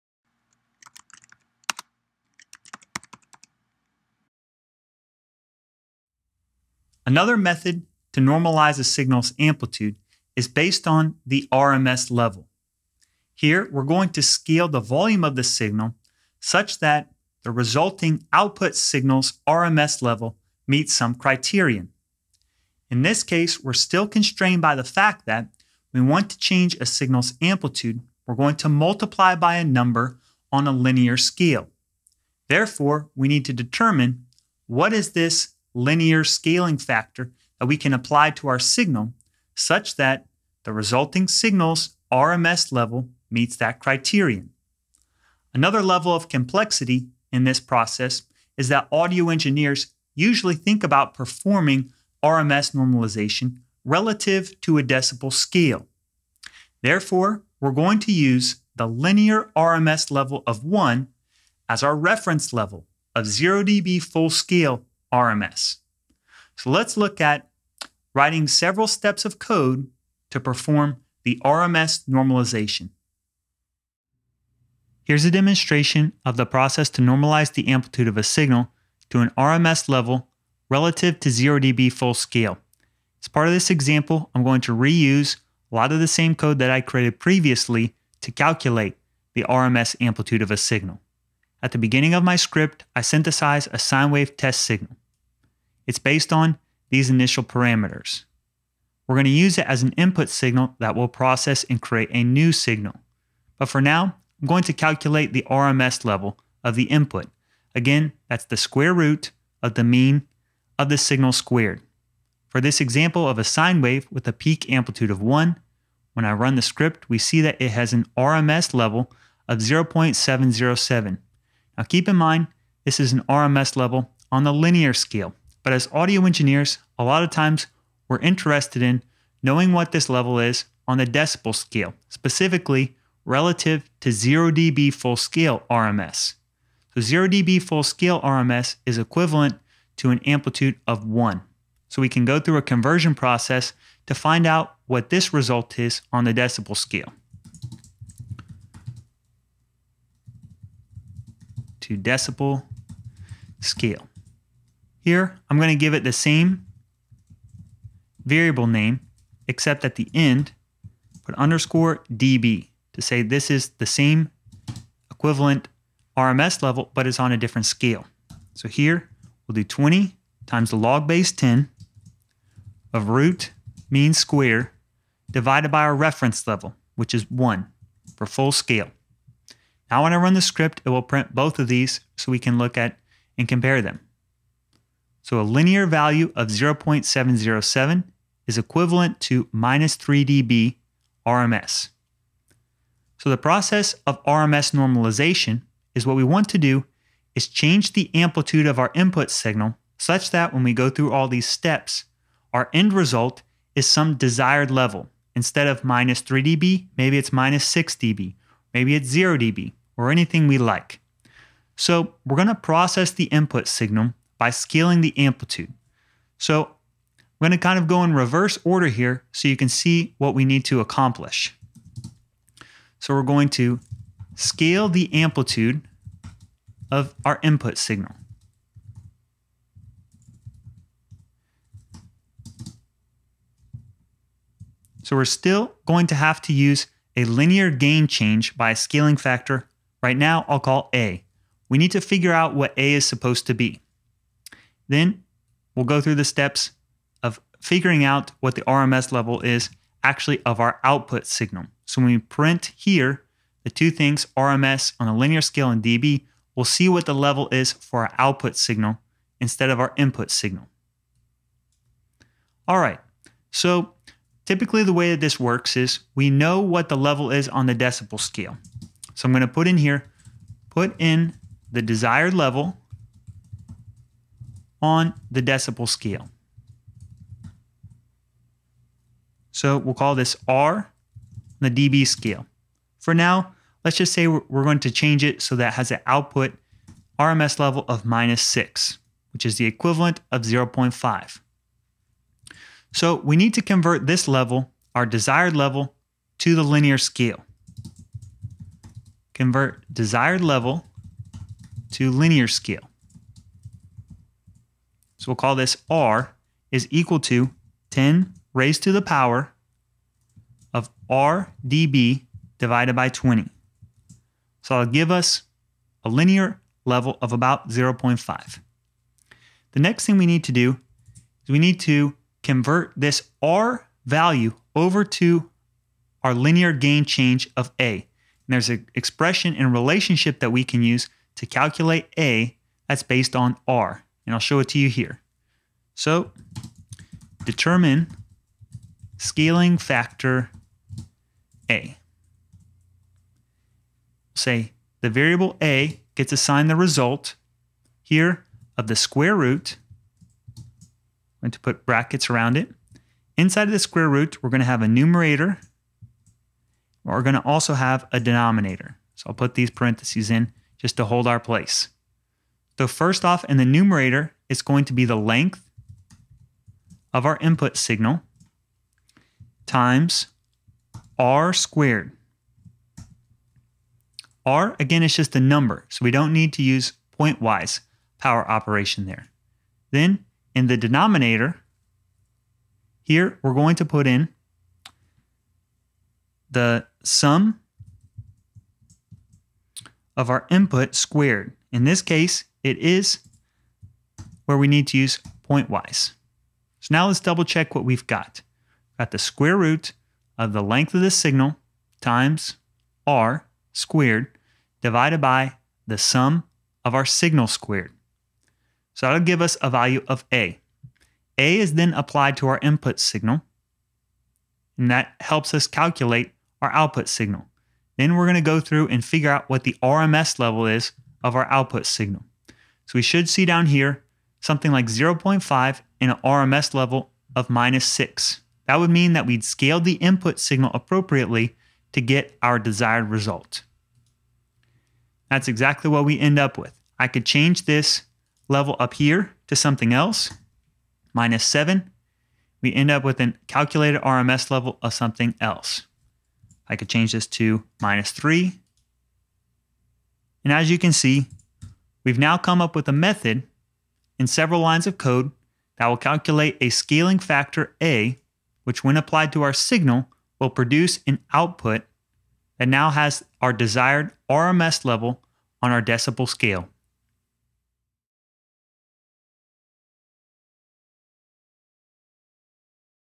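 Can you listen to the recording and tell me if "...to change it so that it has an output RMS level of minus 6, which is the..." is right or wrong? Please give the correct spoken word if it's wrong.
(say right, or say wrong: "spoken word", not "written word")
right.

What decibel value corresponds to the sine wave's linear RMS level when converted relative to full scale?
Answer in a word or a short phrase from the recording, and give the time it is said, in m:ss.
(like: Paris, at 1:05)
-3 dB, at 3:09.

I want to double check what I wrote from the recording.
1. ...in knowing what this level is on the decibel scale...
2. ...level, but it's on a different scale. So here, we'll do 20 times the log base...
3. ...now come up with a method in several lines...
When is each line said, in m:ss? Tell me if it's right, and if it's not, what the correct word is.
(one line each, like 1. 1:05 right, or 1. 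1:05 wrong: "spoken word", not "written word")
1. 2:08 right
2. 2:46 right
3. 7:32 right.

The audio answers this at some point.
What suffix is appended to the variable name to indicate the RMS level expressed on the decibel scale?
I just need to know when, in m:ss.
2:41.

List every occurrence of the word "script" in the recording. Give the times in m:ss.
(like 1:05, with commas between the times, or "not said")
1:32, 1:56, 3:00.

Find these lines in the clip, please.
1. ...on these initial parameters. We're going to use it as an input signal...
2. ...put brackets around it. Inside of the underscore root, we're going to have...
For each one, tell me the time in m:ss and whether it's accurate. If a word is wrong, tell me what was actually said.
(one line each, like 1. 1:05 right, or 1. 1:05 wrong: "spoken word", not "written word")
1. 1:36 right
2. 5:51 wrong: "square", not "underscore".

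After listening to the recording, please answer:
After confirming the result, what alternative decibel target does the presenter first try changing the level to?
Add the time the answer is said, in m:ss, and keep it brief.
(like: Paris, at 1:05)
-7, at 7:21.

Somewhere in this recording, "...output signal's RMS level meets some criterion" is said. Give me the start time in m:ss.
0:18.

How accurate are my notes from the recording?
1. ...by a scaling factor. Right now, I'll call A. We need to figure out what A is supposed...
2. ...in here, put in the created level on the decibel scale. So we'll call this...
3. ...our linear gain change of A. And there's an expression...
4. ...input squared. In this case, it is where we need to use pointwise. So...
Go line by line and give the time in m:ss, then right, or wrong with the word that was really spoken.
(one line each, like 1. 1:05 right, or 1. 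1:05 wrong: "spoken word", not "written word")
1. 3:58 right
2. 4:29 wrong: "desired", not "created"
3. 5:26 right
4. 6:30 right.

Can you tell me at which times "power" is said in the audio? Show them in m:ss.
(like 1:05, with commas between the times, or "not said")
5:09, 6:18.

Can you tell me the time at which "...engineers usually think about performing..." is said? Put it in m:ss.
0:49.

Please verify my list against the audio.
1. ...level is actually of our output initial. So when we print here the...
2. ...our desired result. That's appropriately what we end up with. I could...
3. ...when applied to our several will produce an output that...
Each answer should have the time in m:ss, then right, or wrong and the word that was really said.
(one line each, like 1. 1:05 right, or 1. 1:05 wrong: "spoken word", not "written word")
1. 4:09 wrong: "signal", not "initial"
2. 7:12 wrong: "exactly", not "appropriately"
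3. 7:38 wrong: "signal", not "several".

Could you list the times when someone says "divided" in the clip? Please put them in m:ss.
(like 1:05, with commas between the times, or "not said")
2:55, 5:12, 6:44.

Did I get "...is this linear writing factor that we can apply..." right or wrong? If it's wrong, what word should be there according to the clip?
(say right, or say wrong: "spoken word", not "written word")
wrong: "scaling", not "writing".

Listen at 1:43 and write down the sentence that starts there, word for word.
But for now, I'm going to calculate the RMS level of the input.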